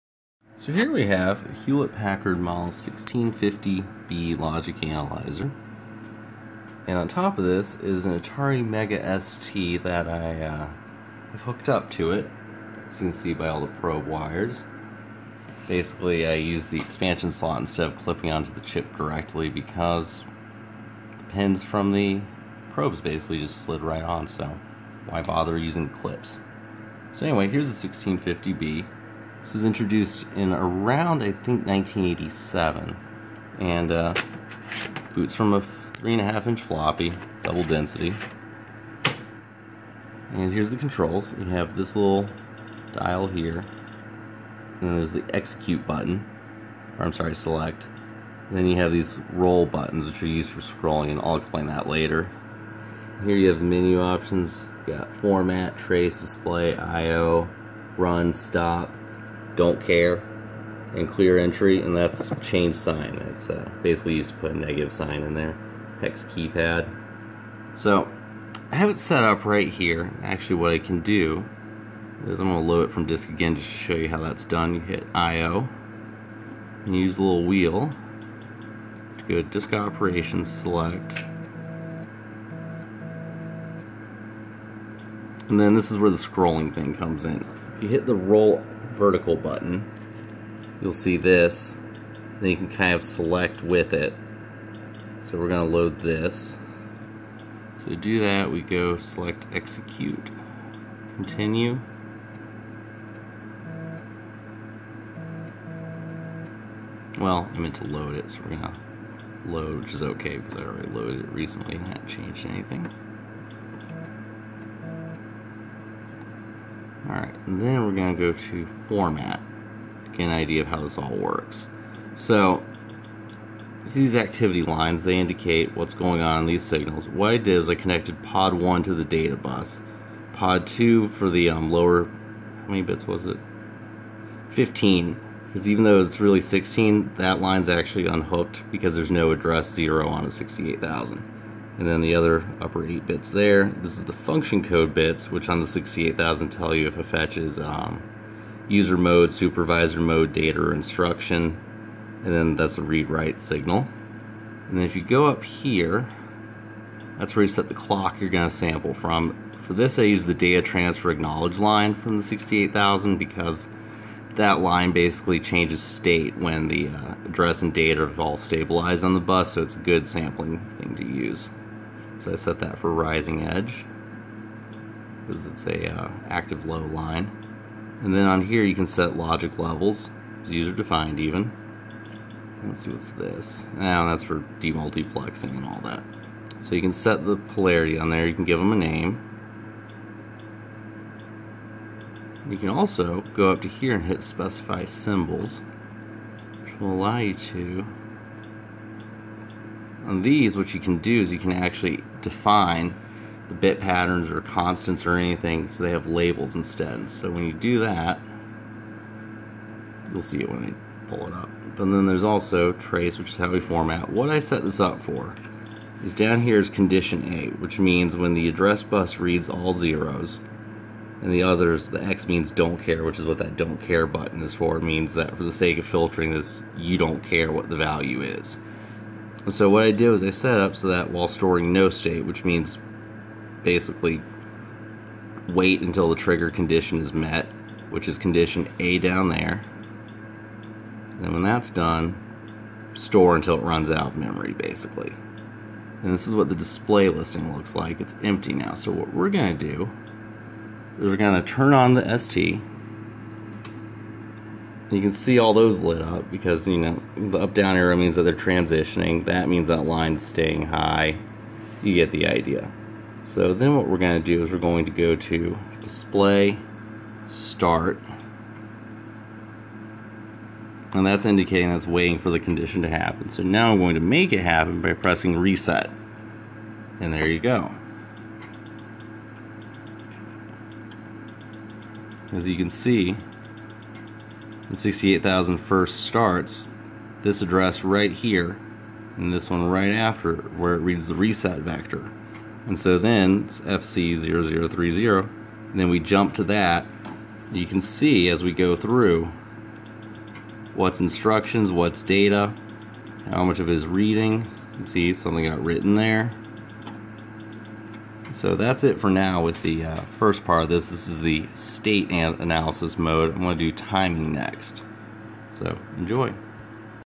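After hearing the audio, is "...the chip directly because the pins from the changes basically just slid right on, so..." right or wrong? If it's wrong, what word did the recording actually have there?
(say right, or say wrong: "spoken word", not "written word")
wrong: "probes", not "changes".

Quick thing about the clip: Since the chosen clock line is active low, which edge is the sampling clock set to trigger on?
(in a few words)
Rising edge.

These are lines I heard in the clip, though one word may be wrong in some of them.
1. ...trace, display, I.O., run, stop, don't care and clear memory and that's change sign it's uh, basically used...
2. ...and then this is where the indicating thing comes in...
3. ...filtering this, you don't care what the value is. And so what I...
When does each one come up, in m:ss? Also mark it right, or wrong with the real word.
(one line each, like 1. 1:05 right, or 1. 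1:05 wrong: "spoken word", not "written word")
1. 0:55 wrong: "entry", not "memory"
2. 1:25 wrong: "scrolling", not "indicating"
3. 3:45 right.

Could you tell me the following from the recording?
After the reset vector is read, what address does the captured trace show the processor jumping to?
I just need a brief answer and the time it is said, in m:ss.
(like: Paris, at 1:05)
FC0030, at 4:53.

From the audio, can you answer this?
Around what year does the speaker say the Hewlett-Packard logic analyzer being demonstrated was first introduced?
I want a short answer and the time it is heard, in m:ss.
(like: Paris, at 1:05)
1987, at 0:31.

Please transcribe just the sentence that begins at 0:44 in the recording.
And there's the execute button, or I'm sorry, select.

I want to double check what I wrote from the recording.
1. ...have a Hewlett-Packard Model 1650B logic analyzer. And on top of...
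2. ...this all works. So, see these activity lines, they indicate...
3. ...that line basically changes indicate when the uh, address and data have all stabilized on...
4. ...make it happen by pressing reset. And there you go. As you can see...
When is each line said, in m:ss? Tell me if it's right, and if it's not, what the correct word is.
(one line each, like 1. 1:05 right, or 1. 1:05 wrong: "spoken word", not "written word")
1. 0:01 right
2. 2:00 right
3. 2:44 wrong: "state", not "indicate"
4. 4:34 right.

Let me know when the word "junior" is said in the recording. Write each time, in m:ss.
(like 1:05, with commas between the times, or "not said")
not said.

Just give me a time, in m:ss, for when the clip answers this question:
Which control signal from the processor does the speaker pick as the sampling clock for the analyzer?
2:40.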